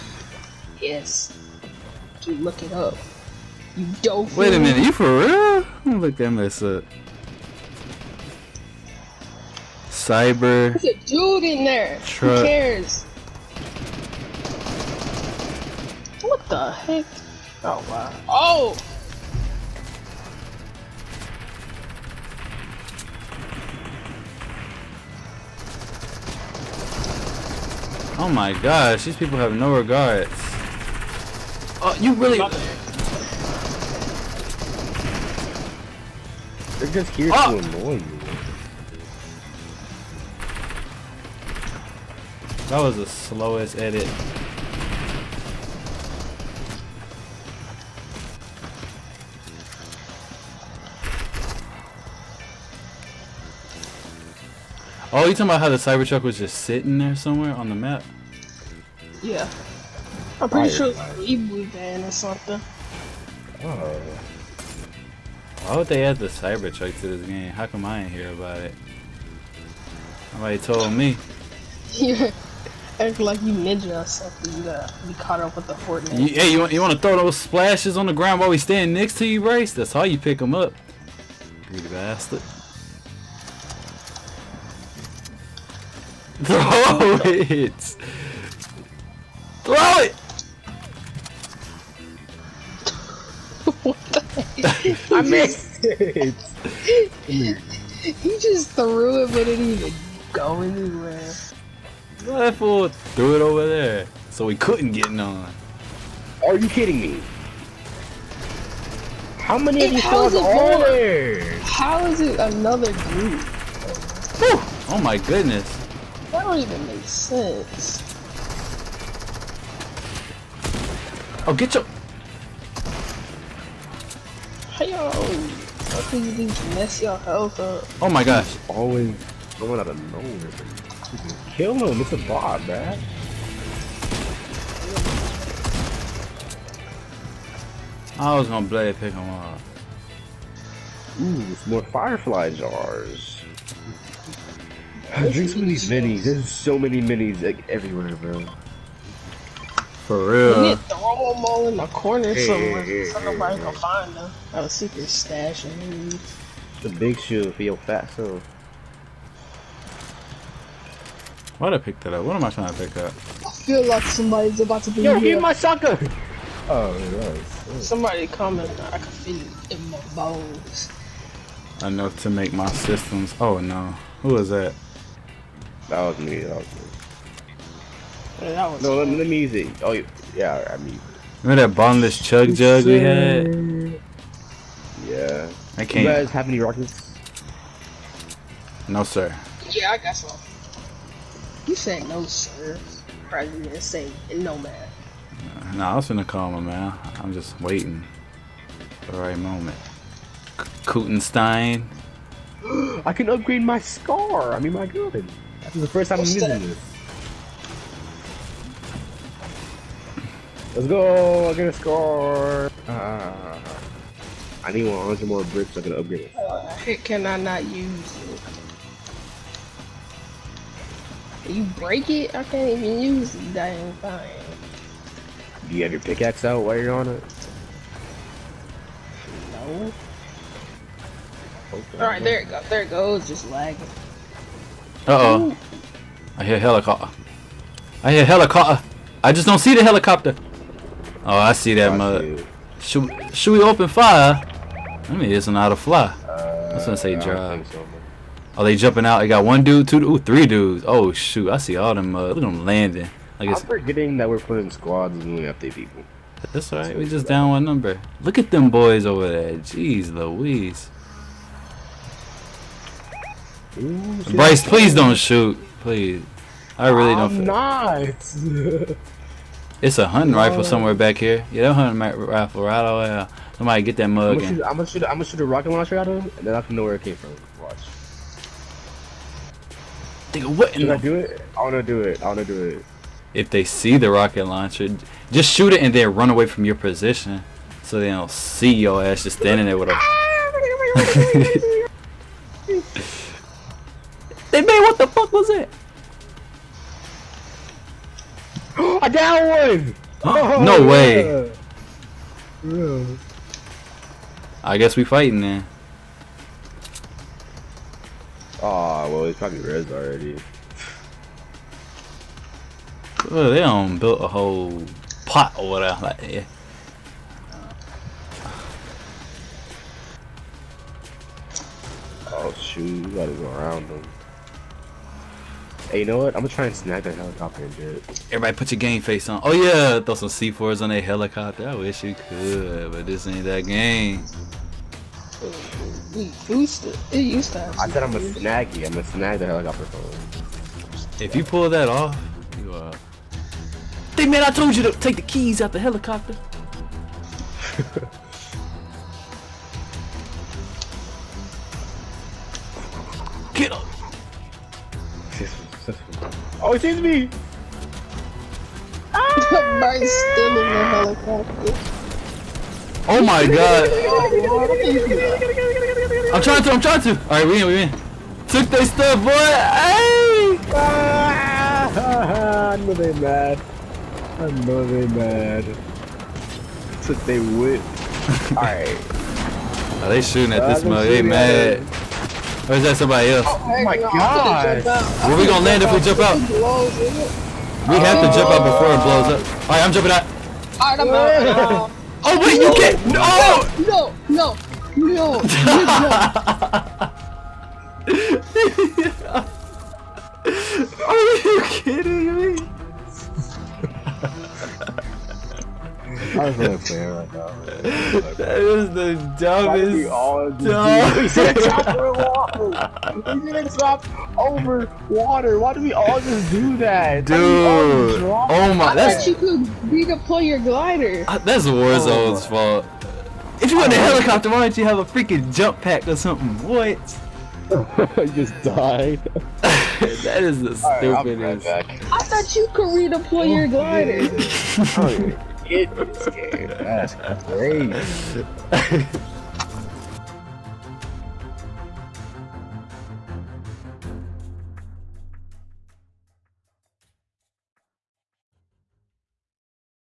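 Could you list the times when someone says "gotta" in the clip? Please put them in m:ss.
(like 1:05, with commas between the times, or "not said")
1:14, 5:23.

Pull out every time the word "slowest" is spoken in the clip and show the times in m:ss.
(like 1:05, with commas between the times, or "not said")
0:43.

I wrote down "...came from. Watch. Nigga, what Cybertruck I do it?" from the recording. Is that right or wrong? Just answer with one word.
wrong.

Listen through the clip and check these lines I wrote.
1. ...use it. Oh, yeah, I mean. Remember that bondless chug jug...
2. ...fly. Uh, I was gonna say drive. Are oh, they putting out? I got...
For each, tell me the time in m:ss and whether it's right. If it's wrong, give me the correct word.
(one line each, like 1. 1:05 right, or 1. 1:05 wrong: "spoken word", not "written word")
1. 2:59 right
2. 4:05 wrong: "jumping", not "putting".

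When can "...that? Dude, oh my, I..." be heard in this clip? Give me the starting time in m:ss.
6:56.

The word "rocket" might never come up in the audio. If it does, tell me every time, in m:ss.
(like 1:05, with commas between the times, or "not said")
3:06, 4:35, 4:44.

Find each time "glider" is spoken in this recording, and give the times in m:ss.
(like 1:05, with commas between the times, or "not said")
7:00, 7:13.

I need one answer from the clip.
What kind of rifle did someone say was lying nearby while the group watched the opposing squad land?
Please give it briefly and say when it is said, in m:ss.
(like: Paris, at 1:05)
hunting rifle, at 4:31.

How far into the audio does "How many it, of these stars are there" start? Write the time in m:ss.
1:49.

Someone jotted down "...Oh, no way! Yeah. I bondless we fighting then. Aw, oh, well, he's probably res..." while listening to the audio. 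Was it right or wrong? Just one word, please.
wrong.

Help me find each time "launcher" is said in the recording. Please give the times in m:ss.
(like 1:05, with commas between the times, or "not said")
4:35, 4:44.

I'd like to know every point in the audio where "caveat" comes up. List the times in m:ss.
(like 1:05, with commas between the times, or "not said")
not said.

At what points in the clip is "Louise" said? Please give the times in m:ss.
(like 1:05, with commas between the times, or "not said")
4:20.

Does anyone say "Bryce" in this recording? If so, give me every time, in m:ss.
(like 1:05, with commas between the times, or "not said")
4:24.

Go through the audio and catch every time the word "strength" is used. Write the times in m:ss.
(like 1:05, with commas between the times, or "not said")
not said.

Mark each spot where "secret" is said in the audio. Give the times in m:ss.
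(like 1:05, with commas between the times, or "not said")
2:34.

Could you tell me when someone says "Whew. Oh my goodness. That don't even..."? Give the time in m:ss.
1:54.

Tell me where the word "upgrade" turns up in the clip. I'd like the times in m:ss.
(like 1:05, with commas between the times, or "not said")
3:23, 3:35.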